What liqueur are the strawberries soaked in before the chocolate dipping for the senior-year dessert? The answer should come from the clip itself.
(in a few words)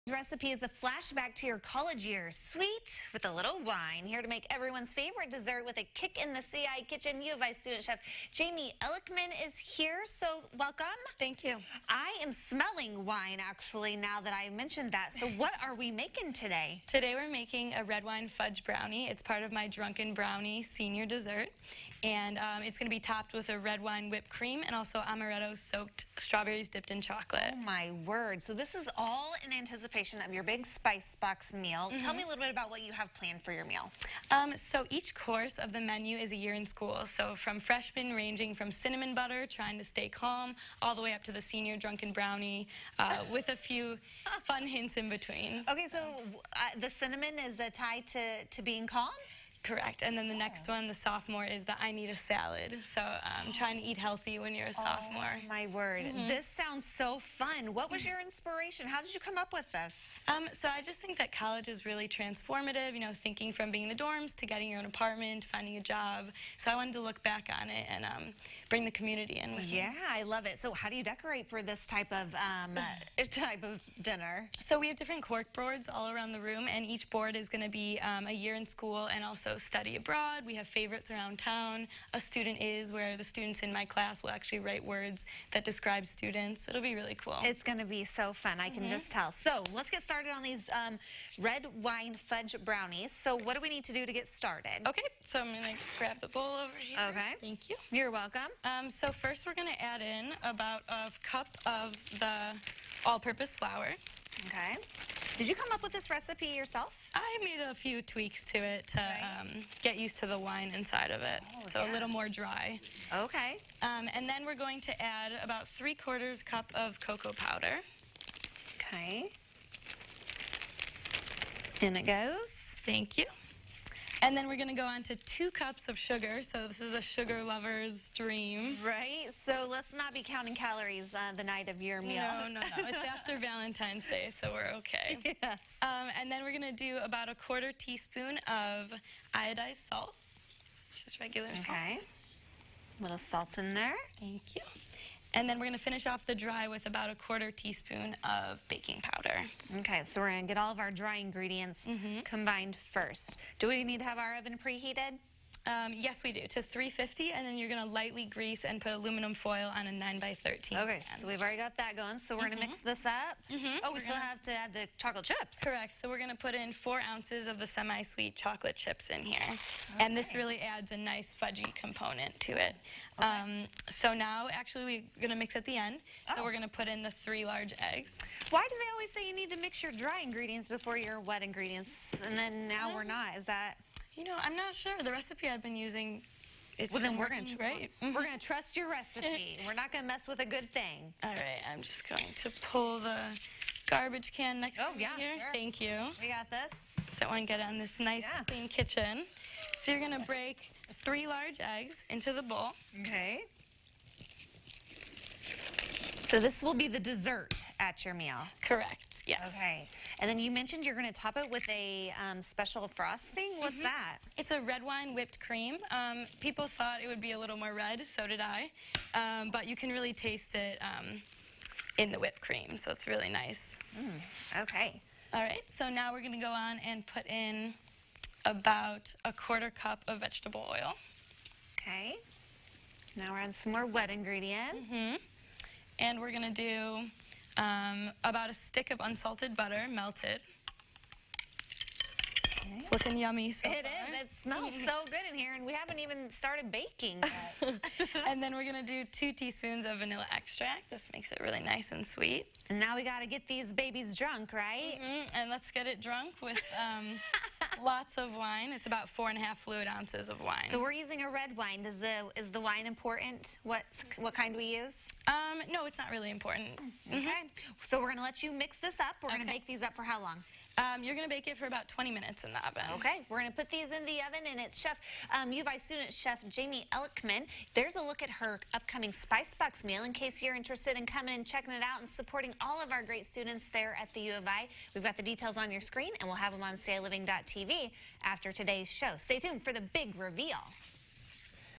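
amaretto.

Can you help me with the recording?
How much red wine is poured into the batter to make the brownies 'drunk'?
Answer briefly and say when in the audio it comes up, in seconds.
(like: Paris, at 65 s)
4.5 fluid ounces, at 259 s.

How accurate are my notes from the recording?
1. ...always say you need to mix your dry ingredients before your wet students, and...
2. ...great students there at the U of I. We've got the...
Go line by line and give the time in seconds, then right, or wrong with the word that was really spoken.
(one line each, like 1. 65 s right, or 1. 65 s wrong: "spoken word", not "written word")
1. 178 s wrong: "ingredients", not "students"
2. 283 s right.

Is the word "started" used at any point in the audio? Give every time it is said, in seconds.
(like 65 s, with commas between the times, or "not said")
90 s, 94 s, 246 s.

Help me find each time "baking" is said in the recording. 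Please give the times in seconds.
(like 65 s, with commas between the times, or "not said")
148 s, 246 s.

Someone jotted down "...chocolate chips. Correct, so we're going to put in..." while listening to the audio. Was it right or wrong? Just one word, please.
right.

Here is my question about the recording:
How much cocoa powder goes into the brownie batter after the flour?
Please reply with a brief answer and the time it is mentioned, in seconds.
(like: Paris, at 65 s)
3/4 cup, at 115 s.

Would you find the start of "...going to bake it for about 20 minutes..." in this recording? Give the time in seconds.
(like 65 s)
271 s.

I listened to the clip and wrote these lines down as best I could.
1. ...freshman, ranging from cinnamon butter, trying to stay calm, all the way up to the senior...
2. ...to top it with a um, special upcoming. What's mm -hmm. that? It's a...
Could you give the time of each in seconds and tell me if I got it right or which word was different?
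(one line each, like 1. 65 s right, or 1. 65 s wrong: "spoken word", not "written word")
1. 37 s right
2. 211 s wrong: "frosting", not "upcoming".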